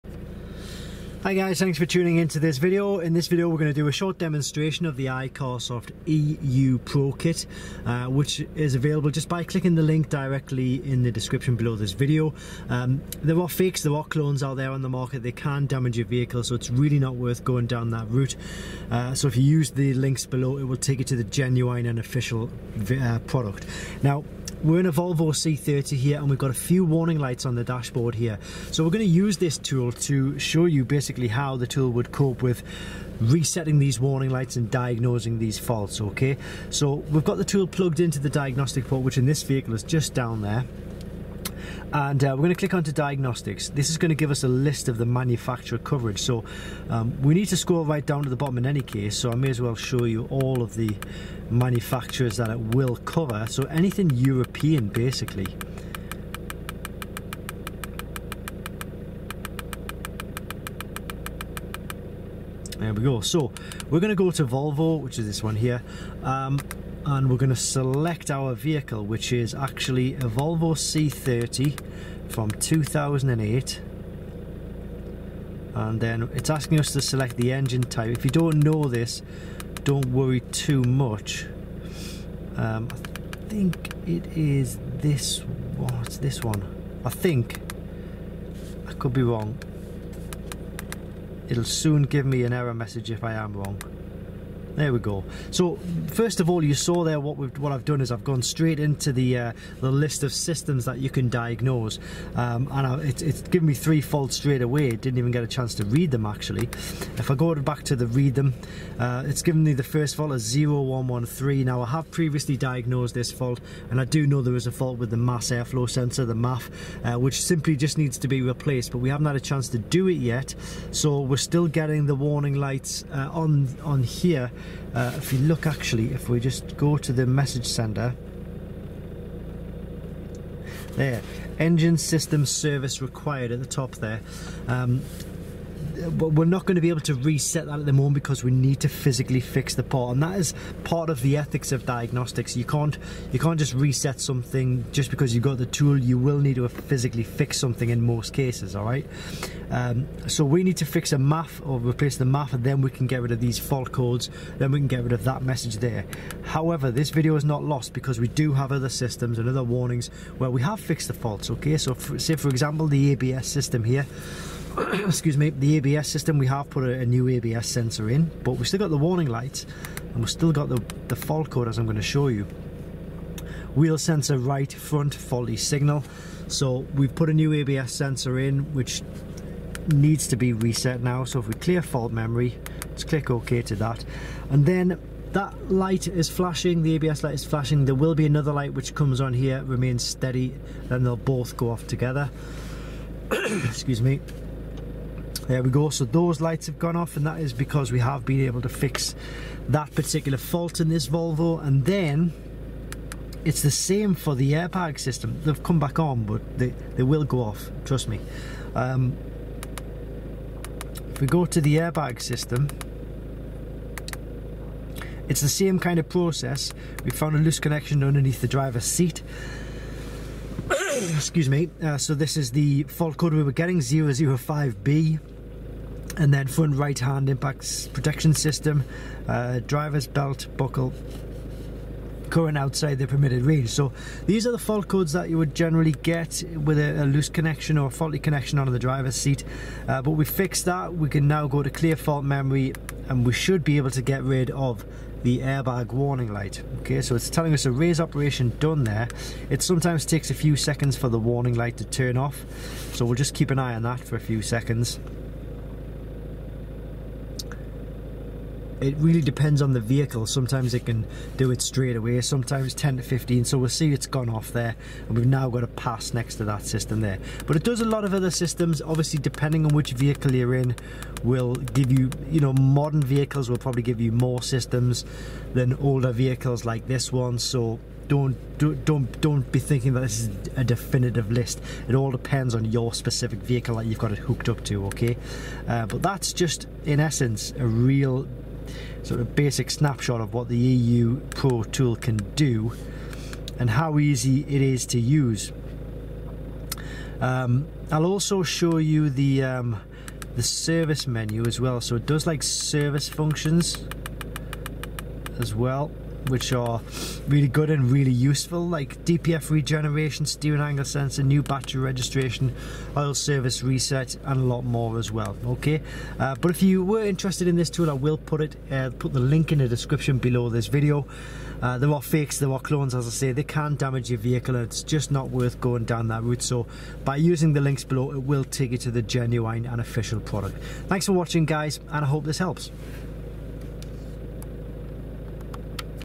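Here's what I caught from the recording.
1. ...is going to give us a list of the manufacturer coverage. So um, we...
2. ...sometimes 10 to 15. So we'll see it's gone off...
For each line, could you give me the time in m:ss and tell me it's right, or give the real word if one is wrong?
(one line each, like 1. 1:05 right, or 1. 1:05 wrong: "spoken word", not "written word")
1. 0:43 right
2. 4:22 right.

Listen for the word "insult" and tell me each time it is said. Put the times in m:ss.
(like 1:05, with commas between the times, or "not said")
not said.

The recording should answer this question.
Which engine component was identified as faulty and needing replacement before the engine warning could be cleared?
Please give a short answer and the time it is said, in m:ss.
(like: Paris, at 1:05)
mass airflow sensor, at 1:55.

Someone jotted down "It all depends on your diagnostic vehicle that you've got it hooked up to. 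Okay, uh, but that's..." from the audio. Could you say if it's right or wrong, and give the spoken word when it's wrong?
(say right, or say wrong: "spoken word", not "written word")
wrong: "specific", not "diagnostic".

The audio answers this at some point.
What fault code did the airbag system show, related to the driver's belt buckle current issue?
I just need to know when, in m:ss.
3:43.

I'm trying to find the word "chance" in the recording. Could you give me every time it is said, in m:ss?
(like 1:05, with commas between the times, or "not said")
1:45, 1:59.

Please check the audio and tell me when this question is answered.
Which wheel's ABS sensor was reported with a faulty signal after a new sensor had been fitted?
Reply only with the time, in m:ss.
2:54.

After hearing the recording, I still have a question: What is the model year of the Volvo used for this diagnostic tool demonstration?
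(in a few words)
2008.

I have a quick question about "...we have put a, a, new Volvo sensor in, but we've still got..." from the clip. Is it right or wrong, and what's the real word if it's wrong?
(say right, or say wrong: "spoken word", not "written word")
wrong: "ABS", not "Volvo".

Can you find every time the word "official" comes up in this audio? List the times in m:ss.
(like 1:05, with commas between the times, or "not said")
0:21, 5:29.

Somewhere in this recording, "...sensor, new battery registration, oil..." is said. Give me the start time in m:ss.
5:10.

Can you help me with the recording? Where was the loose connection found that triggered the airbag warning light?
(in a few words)
underneath the driver's seat.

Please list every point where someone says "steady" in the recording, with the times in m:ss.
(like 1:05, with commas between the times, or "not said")
3:10.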